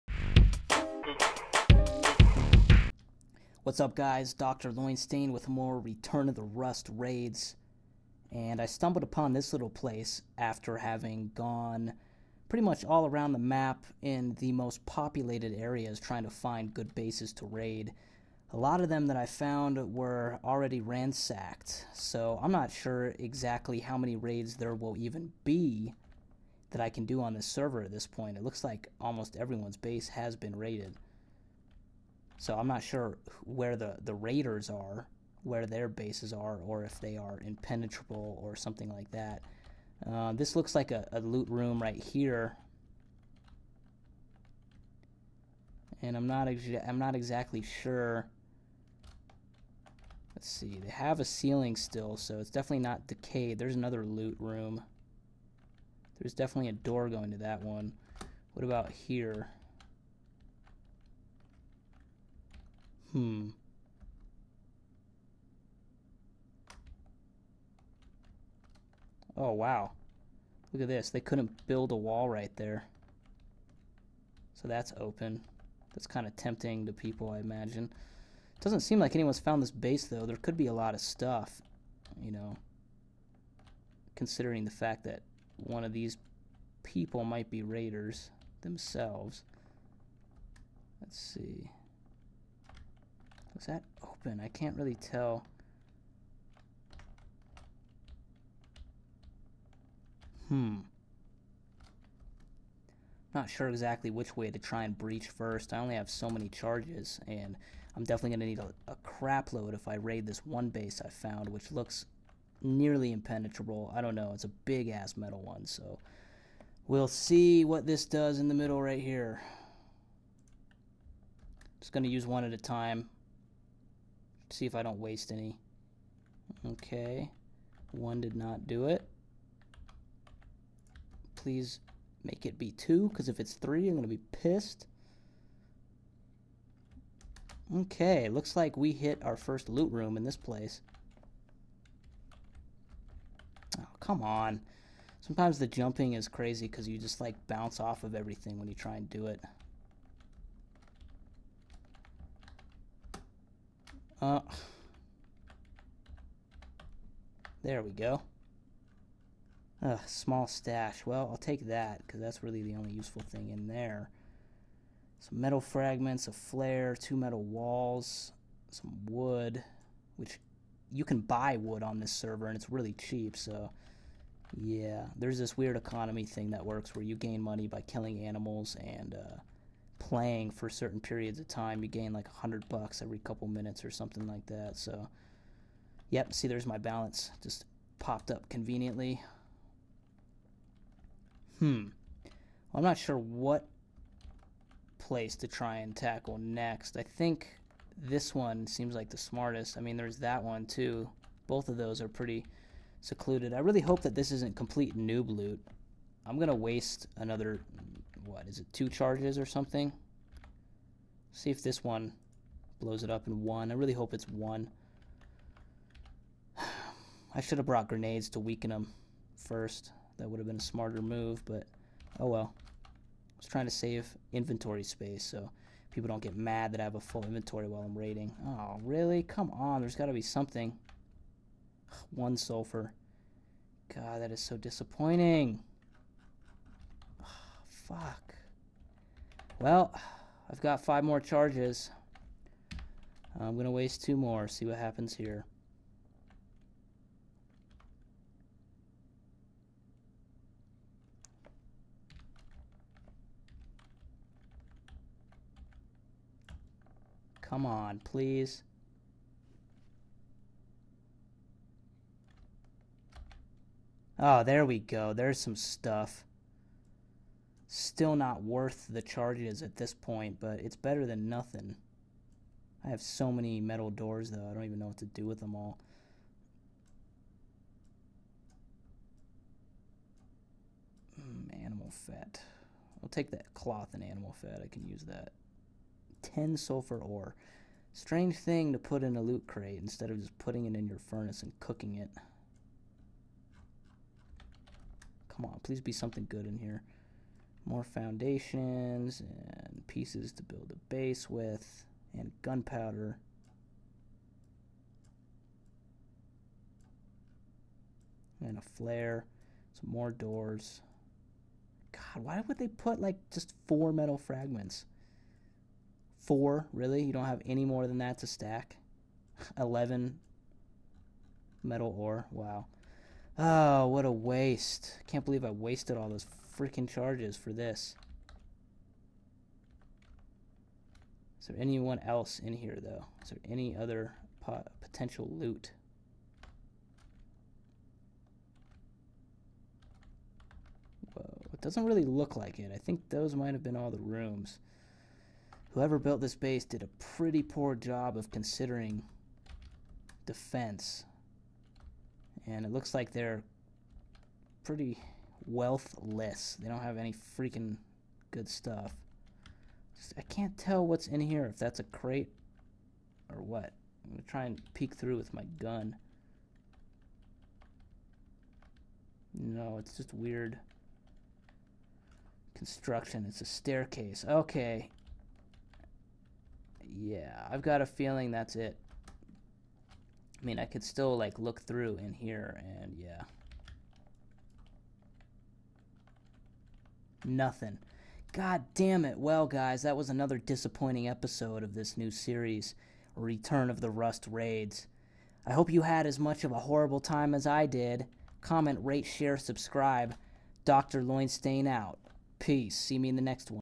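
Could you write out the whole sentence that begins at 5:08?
And a flare, some more doors.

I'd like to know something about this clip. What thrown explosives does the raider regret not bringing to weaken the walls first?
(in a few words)
grenades.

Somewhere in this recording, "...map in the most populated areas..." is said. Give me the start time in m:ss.
0:13.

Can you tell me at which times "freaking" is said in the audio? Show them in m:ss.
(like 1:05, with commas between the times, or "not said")
5:26, 5:57.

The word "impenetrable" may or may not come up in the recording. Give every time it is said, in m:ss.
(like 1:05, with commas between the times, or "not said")
0:37, 1:53.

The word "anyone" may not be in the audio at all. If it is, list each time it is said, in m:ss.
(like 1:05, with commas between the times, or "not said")
1:19, 5:31.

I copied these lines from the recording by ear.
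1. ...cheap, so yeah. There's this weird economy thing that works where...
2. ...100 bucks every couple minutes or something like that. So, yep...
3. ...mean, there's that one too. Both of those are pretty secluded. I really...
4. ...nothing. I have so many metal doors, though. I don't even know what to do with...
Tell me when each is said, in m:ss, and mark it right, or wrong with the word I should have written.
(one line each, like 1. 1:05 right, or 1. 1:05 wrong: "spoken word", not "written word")
1. 2:52 right
2. 3:02 right
3. 3:19 right
4. 4:31 right.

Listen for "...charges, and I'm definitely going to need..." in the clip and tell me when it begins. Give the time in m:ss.
1:46.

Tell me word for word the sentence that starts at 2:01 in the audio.
Just going to use one at a time see if I don't waste any.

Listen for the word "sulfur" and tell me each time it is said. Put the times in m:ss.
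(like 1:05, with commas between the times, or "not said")
3:52, 4:46.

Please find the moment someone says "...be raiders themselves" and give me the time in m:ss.
1:27.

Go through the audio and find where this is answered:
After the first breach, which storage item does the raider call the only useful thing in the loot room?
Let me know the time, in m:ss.
2:40.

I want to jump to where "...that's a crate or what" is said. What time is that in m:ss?
6:01.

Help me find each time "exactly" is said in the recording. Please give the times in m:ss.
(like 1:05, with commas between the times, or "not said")
0:23, 0:47, 1:43.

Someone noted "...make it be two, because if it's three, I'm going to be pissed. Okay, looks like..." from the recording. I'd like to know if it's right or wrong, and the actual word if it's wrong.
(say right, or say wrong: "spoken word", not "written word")
right.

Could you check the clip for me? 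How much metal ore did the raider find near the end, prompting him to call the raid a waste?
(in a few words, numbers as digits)
11.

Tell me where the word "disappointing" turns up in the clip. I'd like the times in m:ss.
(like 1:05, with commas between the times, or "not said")
3:54, 6:30.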